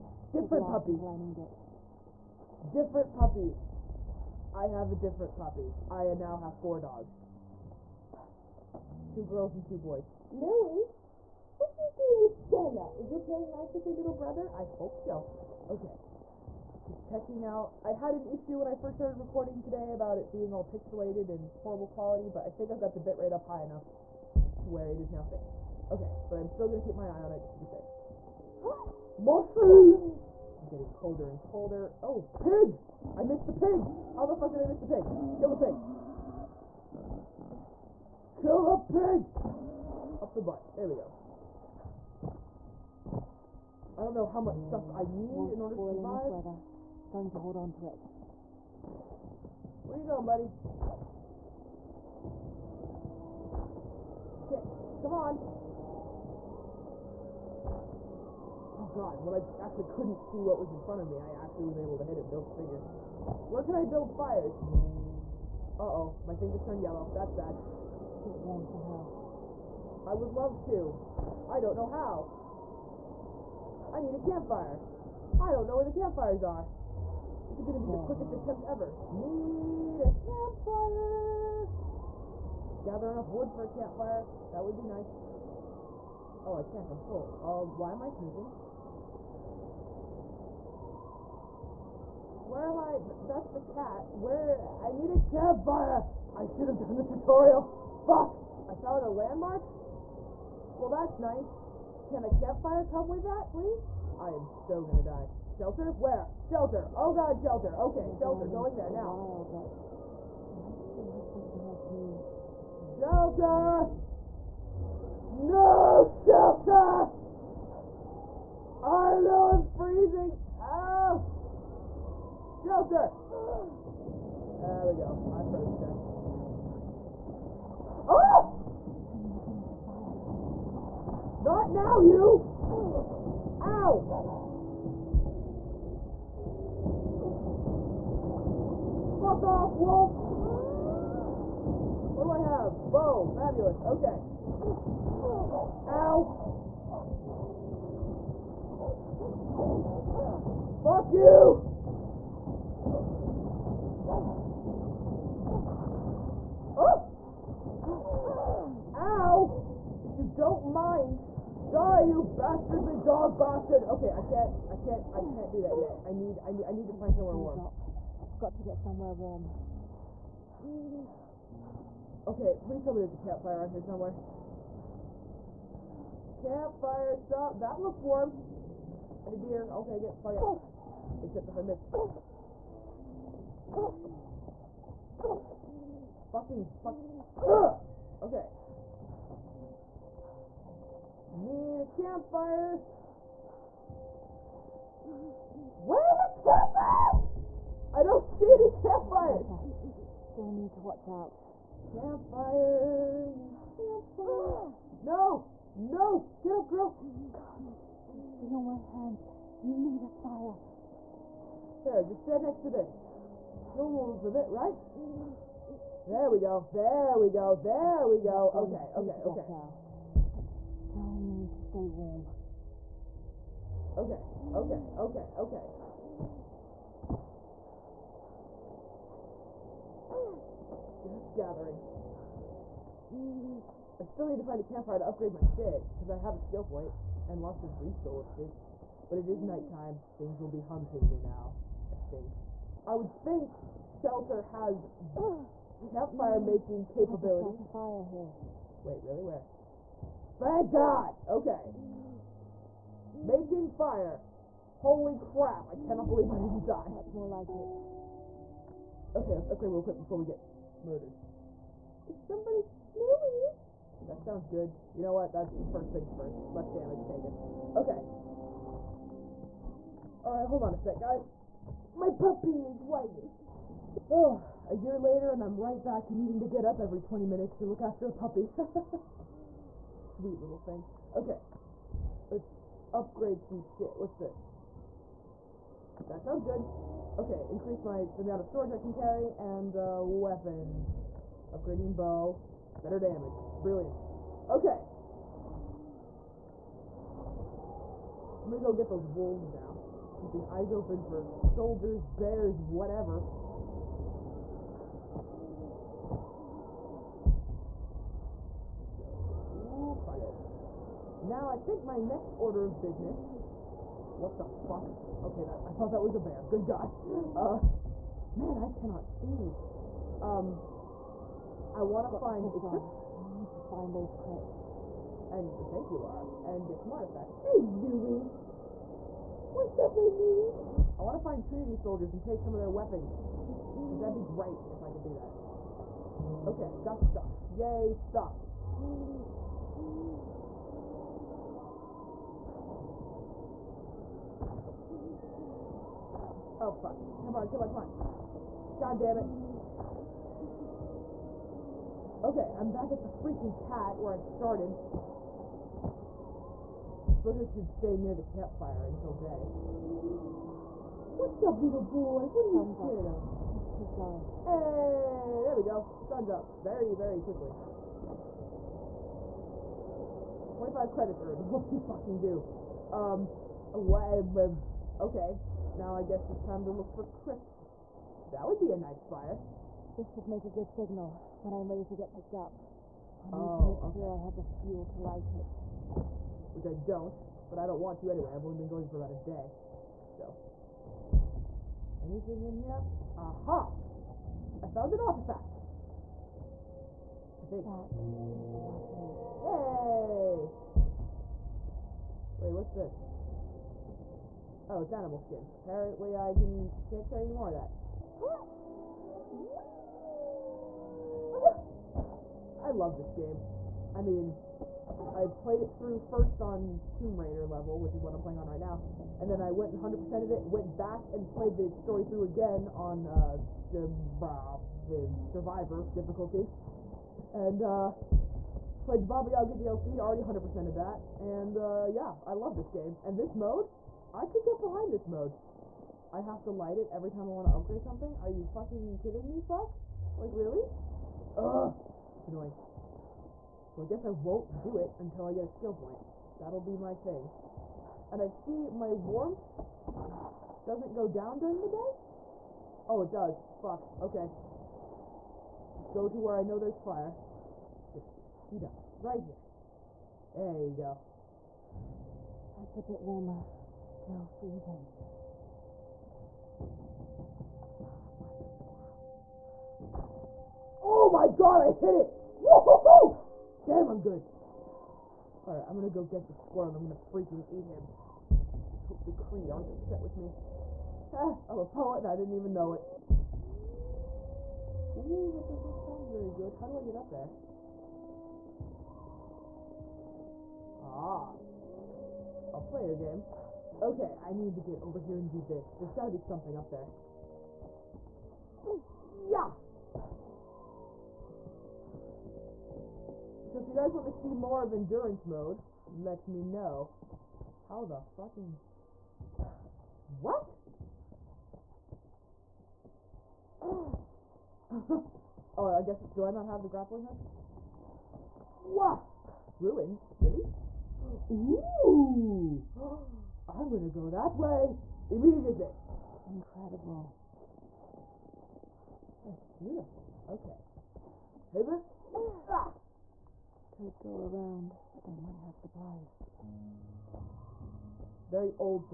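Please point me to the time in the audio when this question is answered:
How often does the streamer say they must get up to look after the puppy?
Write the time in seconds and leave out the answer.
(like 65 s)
276 s.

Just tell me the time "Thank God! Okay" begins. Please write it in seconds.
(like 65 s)
250 s.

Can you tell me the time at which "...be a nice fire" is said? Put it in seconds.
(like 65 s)
378 s.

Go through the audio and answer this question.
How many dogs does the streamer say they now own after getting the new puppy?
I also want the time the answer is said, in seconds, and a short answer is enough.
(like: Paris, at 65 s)
4, at 6 s.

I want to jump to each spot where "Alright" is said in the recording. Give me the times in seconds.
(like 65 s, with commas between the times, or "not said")
270 s, 475 s.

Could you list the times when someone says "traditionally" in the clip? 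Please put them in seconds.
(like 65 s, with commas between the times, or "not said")
not said.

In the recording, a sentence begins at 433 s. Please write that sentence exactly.
And this mode, I could get behind this mode.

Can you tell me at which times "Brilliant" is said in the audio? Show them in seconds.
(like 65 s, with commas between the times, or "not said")
293 s.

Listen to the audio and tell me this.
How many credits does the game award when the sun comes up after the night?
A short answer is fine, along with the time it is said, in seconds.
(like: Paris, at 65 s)
25, at 370 s.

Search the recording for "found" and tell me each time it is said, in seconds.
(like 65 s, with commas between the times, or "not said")
98 s, 394 s.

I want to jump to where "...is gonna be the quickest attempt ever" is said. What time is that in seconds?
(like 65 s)
77 s.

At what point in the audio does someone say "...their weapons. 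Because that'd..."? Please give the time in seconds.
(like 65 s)
332 s.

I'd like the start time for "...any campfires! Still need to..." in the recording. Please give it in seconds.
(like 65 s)
198 s.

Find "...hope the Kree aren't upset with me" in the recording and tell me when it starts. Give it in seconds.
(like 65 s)
478 s.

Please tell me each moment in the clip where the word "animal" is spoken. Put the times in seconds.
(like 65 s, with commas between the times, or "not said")
404 s.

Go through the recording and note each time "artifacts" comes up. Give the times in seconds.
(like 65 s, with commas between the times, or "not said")
326 s, 395 s.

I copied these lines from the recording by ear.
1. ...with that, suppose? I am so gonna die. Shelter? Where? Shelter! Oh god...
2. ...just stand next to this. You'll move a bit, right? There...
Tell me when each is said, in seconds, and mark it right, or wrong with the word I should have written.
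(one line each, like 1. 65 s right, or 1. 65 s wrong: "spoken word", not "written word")
1. 103 s wrong: "please", not "suppose"
2. 212 s right.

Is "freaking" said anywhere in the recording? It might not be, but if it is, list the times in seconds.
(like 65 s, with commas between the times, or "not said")
353 s, 476 s.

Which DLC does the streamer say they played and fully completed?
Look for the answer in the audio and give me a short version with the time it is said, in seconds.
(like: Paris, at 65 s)
Baba Yaga, at 429 s.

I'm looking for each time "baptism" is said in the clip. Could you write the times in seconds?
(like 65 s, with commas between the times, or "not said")
not said.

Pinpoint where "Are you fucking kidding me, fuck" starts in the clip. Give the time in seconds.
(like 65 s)
438 s.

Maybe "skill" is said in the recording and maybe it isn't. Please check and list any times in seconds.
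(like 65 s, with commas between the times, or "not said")
236 s, 445 s.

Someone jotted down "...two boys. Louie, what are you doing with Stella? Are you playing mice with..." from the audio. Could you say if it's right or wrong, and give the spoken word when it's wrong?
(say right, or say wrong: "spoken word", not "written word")
right.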